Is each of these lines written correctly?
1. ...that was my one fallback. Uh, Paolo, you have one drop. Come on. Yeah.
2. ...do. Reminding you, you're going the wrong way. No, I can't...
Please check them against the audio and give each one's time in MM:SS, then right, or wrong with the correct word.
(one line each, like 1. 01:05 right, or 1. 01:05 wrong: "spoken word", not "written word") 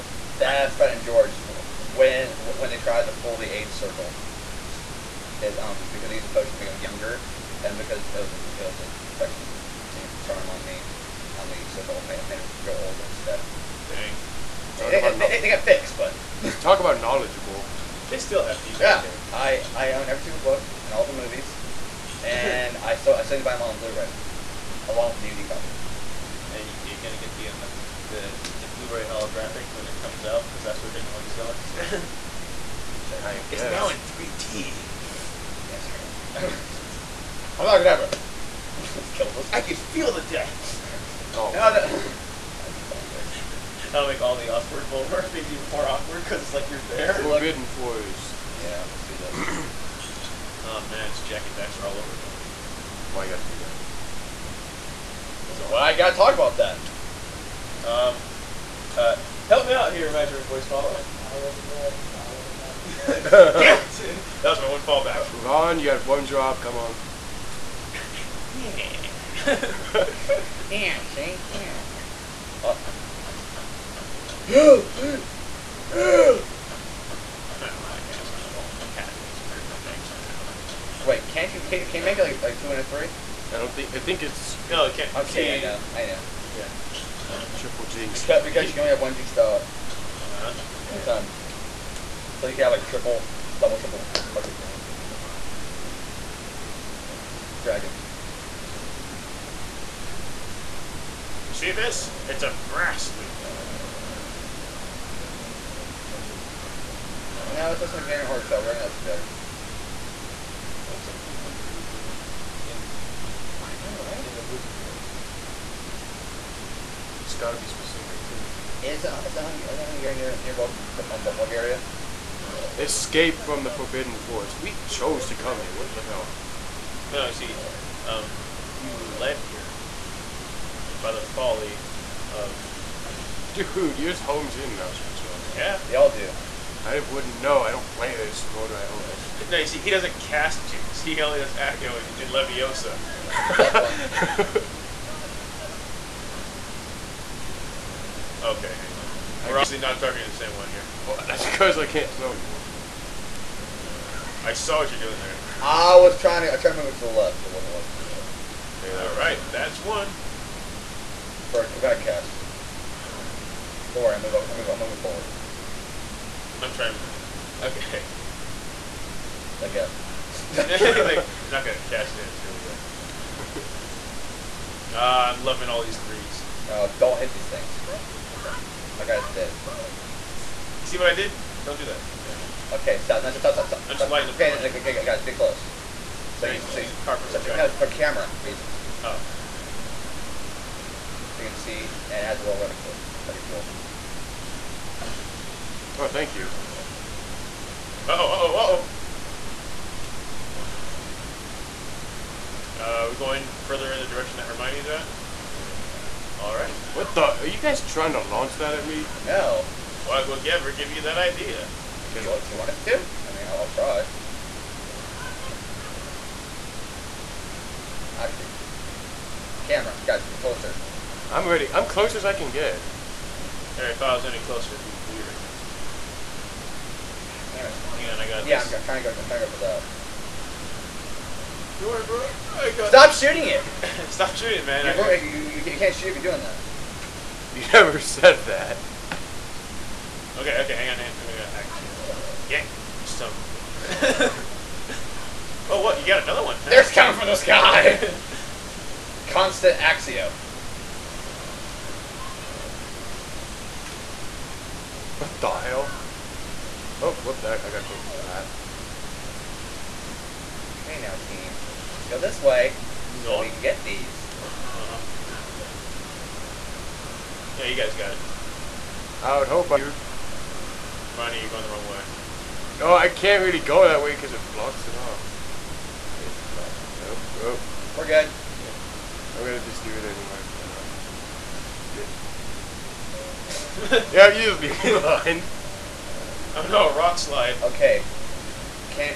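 1. 01:04 wrong: "Ron", not "Paolo"
2. 04:29 right.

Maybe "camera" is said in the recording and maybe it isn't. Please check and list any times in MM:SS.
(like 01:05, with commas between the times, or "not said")
03:07, 03:39.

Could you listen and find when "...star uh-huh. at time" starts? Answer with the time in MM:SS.
01:29.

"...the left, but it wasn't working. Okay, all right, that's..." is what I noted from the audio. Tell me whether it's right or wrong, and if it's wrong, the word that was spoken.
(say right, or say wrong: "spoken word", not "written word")
right.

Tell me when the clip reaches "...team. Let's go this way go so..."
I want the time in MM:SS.
04:21.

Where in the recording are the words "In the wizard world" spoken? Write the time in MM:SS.
01:54.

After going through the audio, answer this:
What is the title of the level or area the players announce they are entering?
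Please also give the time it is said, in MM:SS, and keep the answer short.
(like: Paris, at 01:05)
Escape from the Forbidden Forest, at 02:02.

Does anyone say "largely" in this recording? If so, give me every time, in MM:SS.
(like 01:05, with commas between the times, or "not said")
not said.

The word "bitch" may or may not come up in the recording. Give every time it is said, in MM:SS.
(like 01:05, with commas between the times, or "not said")
04:03.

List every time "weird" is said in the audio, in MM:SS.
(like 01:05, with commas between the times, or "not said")
03:45.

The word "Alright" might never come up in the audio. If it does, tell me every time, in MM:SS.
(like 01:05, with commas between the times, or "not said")
03:26, 03:43.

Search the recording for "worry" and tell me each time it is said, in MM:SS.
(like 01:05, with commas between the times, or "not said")
02:44, 03:51.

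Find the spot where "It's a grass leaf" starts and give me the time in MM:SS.
01:42.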